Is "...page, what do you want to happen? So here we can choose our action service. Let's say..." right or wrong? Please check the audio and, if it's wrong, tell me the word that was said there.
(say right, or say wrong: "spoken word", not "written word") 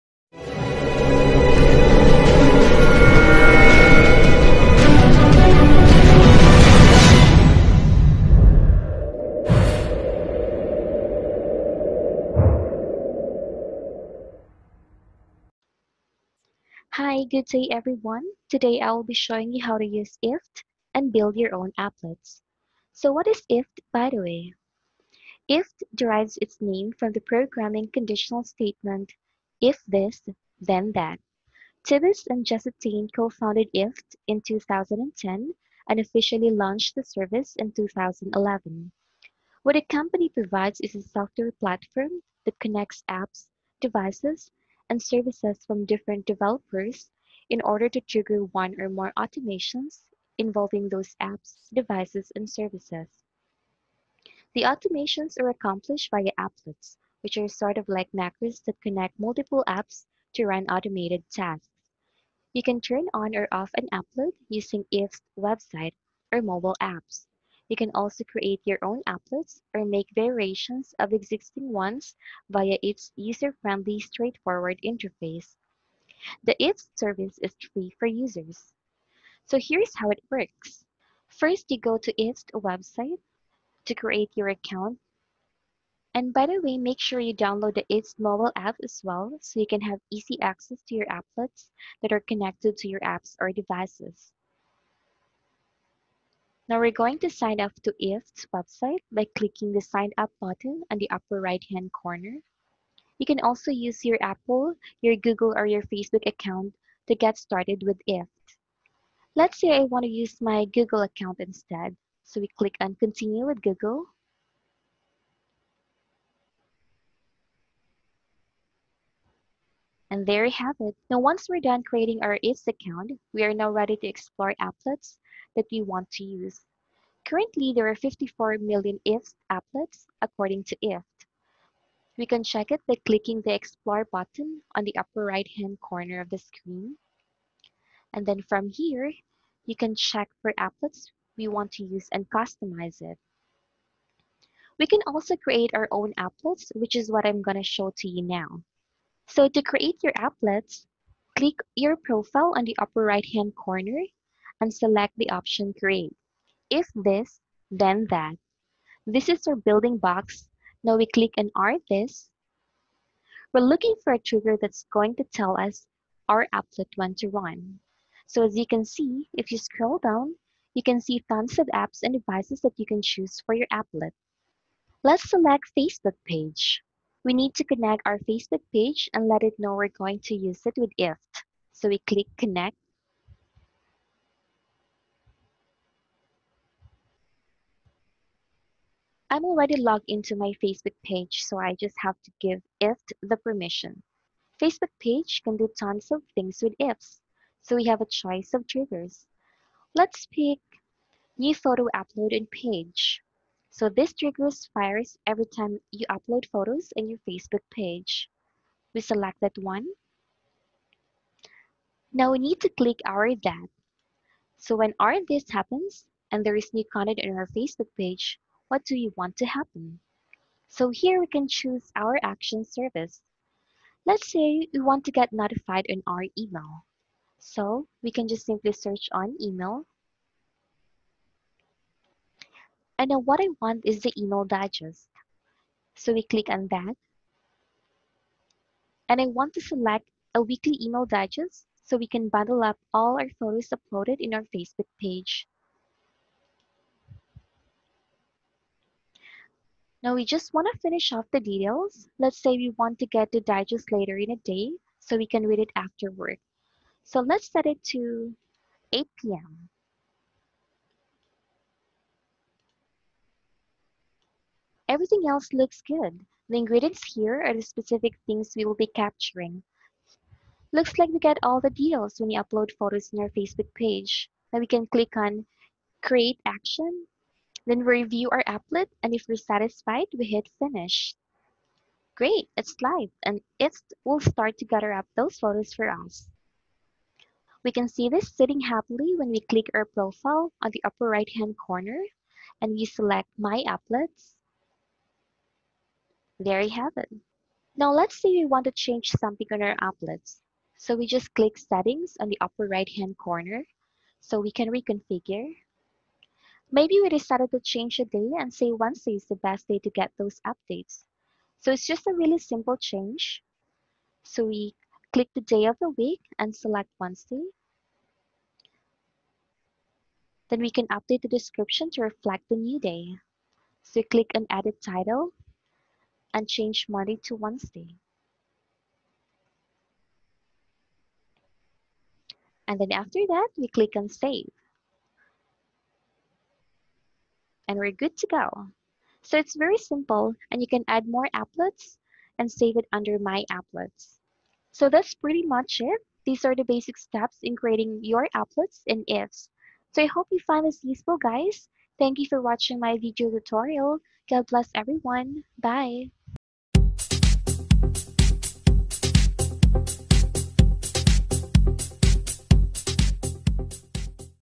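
right.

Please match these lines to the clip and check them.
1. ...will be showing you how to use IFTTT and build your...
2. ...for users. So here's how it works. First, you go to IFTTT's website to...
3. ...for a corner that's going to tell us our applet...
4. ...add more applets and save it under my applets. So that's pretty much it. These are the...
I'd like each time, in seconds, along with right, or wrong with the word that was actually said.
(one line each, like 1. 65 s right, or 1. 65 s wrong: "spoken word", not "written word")
1. 18 s right
2. 77 s right
3. 164 s wrong: "trigger", not "corner"
4. 340 s right.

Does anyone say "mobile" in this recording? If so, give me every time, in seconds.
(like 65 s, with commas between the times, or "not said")
66 s, 88 s.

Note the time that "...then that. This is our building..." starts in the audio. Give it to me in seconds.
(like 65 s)
157 s.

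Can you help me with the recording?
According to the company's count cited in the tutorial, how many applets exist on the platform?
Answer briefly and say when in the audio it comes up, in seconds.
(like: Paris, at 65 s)
54 million, at 127 s.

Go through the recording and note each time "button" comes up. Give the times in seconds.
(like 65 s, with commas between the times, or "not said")
100 s, 134 s.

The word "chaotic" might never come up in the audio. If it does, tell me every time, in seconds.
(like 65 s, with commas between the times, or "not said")
not said.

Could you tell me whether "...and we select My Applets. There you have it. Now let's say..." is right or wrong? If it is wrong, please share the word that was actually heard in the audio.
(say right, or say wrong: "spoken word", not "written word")
right.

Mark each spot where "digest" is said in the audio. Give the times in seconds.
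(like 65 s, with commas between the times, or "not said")
234 s, 241 s, 253 s.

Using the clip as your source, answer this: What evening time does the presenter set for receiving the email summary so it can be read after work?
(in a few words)
8 p.m.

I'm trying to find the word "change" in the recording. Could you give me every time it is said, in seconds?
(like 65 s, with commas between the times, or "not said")
298 s, 307 s, 312 s, 326 s.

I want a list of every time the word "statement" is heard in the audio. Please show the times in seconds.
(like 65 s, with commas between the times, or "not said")
28 s.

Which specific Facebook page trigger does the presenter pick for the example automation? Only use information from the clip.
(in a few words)
New photo upload.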